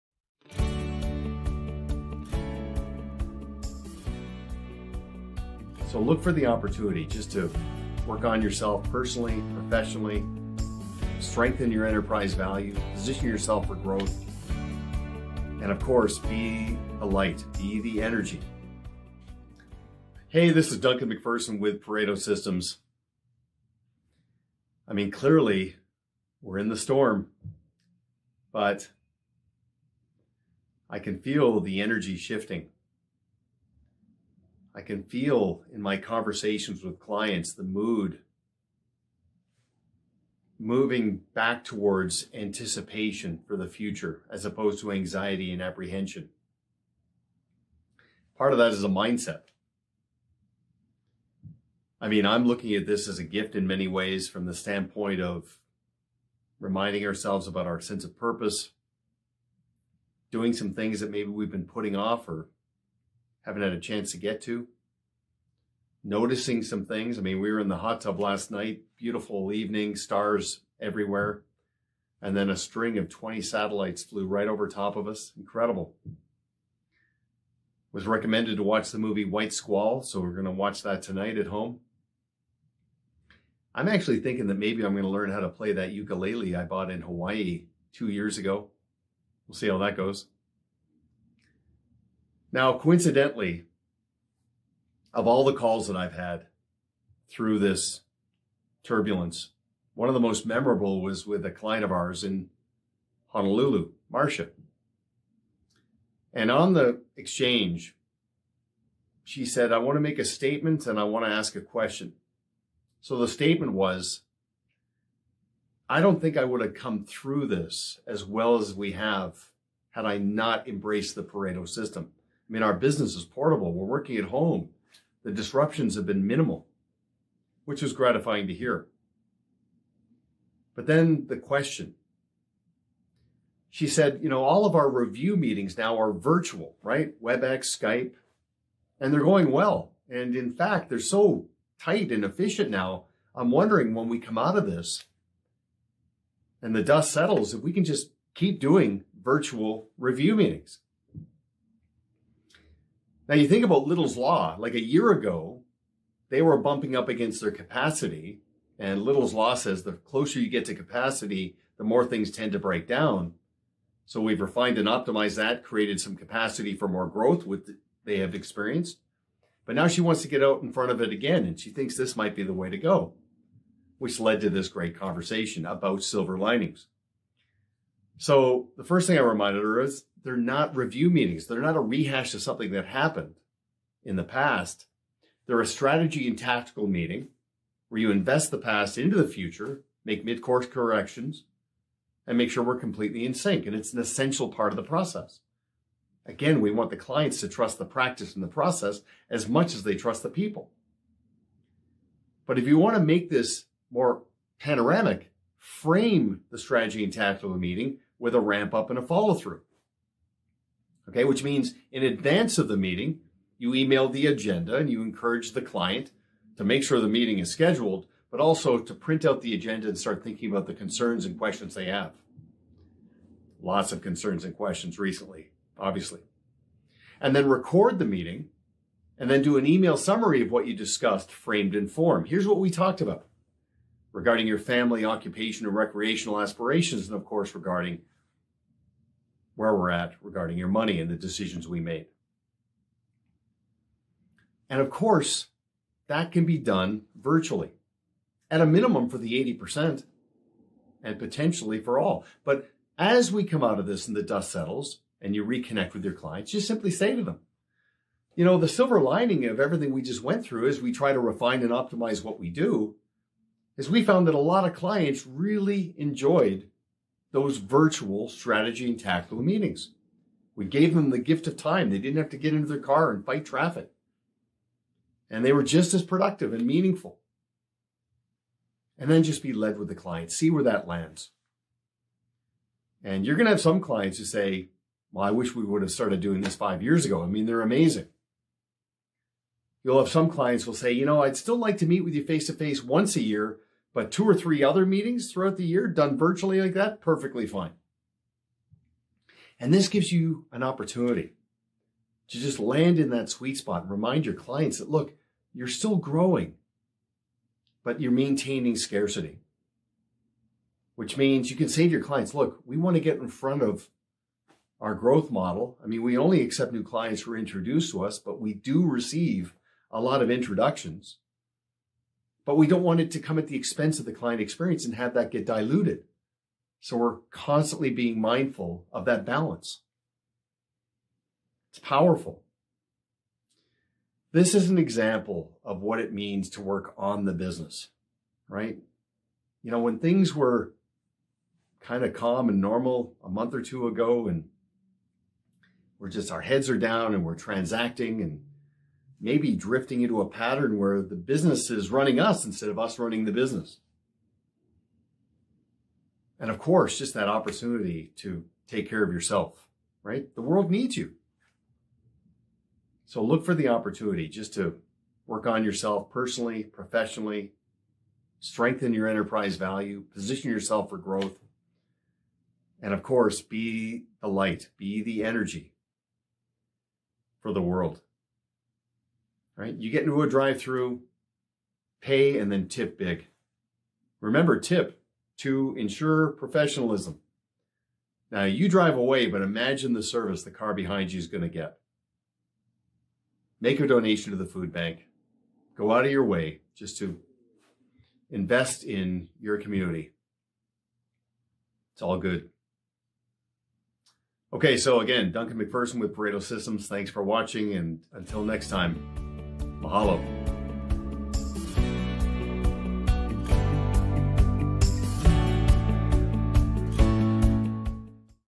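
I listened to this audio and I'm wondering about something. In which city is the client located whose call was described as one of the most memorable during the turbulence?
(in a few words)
Honolulu.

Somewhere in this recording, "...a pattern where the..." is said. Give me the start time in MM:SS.
05:50.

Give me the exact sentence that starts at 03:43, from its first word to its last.
Lots of concerns and questions recently, obviously.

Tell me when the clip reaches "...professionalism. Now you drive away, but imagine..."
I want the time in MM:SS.
06:26.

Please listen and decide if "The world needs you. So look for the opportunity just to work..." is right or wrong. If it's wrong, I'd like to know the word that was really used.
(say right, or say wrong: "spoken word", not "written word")
right.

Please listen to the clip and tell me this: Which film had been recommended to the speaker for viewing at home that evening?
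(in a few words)
White Squall.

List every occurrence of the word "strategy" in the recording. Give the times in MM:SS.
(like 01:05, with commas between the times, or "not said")
03:05, 03:26, 04:28.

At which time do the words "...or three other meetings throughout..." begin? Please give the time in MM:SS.
04:54.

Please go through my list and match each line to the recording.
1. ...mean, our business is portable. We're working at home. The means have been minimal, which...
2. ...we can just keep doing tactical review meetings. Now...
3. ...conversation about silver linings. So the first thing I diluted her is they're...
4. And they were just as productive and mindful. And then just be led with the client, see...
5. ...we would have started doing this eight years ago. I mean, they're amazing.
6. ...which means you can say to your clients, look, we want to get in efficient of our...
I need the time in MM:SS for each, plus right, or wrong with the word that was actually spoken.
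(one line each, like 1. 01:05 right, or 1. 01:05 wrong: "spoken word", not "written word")
1. 02:02 wrong: "disruptions", not "means"
2. 02:27 wrong: "virtual", not "tactical"
3. 02:54 wrong: "reminded", not "diluted"
4. 04:35 wrong: "meaningful", not "mindful"
5. 04:45 wrong: "five", not "eight"
6. 05:10 wrong: "front", not "efficient".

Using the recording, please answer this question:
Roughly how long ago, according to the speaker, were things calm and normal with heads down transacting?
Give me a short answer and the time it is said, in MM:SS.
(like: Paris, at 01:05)
a month or two, at 05:43.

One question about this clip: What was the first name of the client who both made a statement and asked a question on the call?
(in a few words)
Marcia.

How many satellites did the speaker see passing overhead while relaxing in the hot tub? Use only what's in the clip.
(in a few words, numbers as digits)
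20.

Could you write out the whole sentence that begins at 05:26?
So we're constantly being mindful of that balance.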